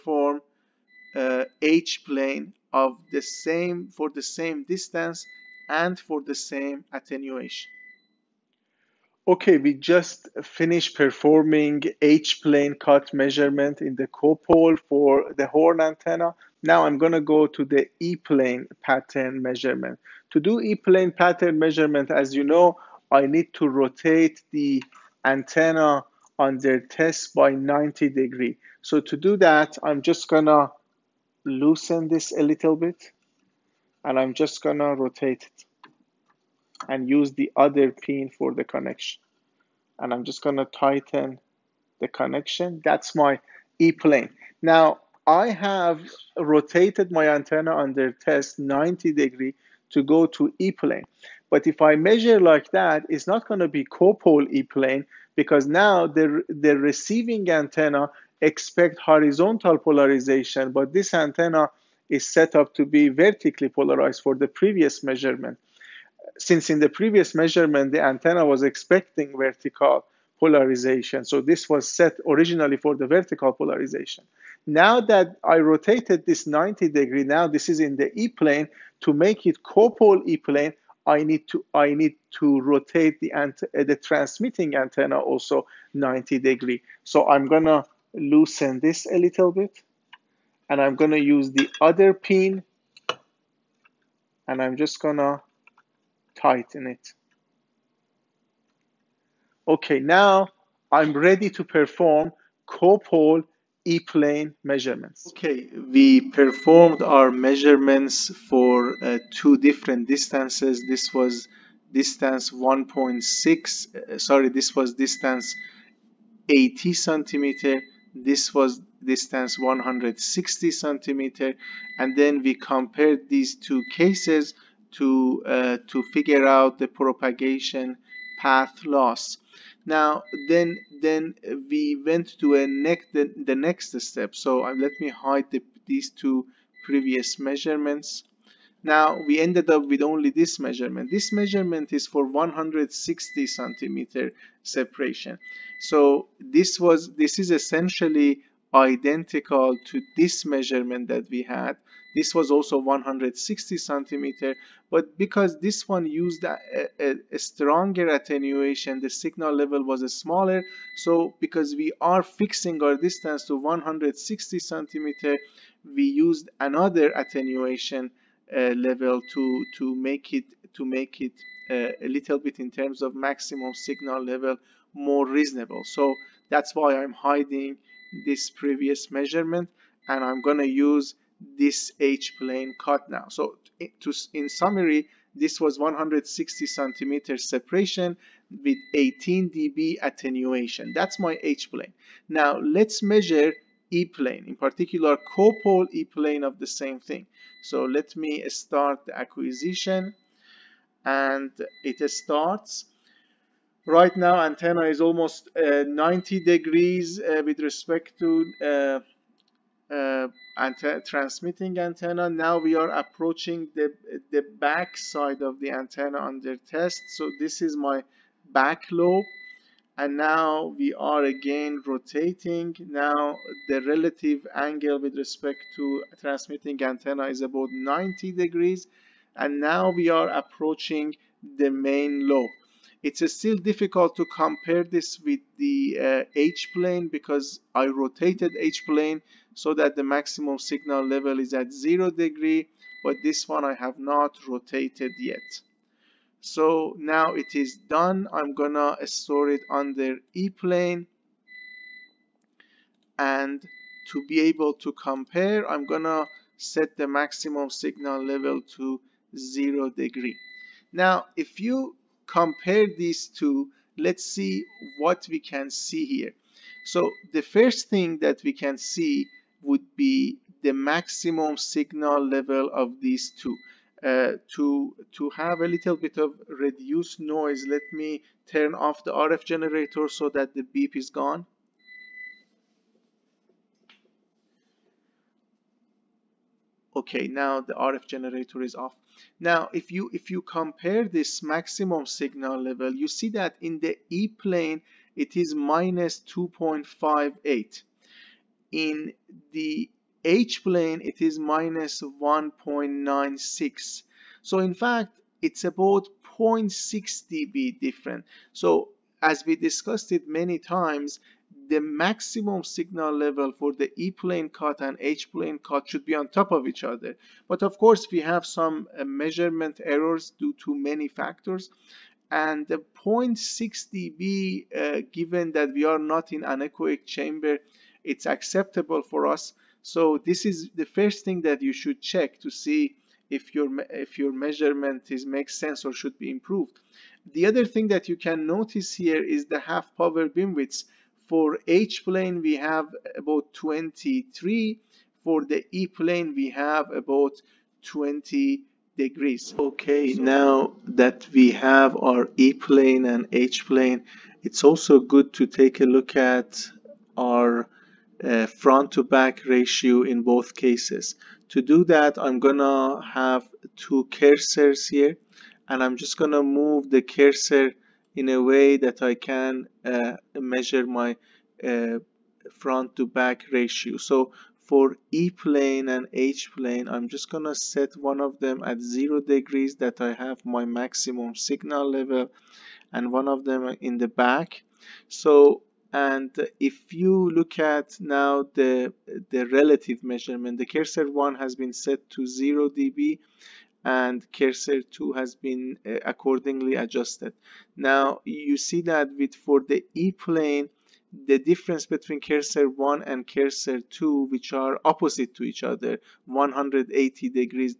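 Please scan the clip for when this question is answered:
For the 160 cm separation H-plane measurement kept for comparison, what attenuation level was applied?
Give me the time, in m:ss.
3:08.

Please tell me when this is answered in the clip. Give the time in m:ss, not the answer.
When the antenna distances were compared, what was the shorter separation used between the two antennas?
1:54.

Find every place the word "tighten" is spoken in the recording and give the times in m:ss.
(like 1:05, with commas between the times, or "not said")
0:40, 1:36.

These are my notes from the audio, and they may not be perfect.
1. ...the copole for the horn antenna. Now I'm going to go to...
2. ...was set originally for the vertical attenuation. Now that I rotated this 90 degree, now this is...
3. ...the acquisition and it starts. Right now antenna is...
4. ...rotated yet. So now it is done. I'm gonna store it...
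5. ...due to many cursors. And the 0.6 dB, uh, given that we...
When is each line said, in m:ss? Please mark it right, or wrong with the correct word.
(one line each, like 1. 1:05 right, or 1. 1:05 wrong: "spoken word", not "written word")
1. 0:13 right
2. 1:11 wrong: "polarization", not "attenuation"
3. 3:19 right
4. 4:04 right
5. 5:20 wrong: "factors", not "cursors".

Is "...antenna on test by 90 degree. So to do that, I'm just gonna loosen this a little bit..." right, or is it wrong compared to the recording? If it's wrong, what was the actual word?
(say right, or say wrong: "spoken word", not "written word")
right.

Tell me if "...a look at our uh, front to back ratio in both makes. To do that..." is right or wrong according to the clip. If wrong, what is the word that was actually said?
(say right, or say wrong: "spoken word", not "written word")
wrong: "cases", not "makes".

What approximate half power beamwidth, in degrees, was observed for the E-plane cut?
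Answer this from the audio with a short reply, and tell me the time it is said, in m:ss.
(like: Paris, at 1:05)
20 degrees, at 5:47.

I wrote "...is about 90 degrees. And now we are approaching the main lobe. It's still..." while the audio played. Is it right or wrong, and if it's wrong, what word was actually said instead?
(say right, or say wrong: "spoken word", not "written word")
right.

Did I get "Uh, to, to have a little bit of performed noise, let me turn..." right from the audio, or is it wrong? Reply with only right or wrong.
wrong.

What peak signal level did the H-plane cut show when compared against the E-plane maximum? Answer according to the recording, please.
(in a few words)
-1.96.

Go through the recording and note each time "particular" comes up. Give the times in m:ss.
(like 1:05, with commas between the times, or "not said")
3:14.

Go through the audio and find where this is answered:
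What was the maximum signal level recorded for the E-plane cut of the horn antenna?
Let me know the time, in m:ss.
4:55.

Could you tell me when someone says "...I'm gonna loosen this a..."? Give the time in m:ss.
1:27.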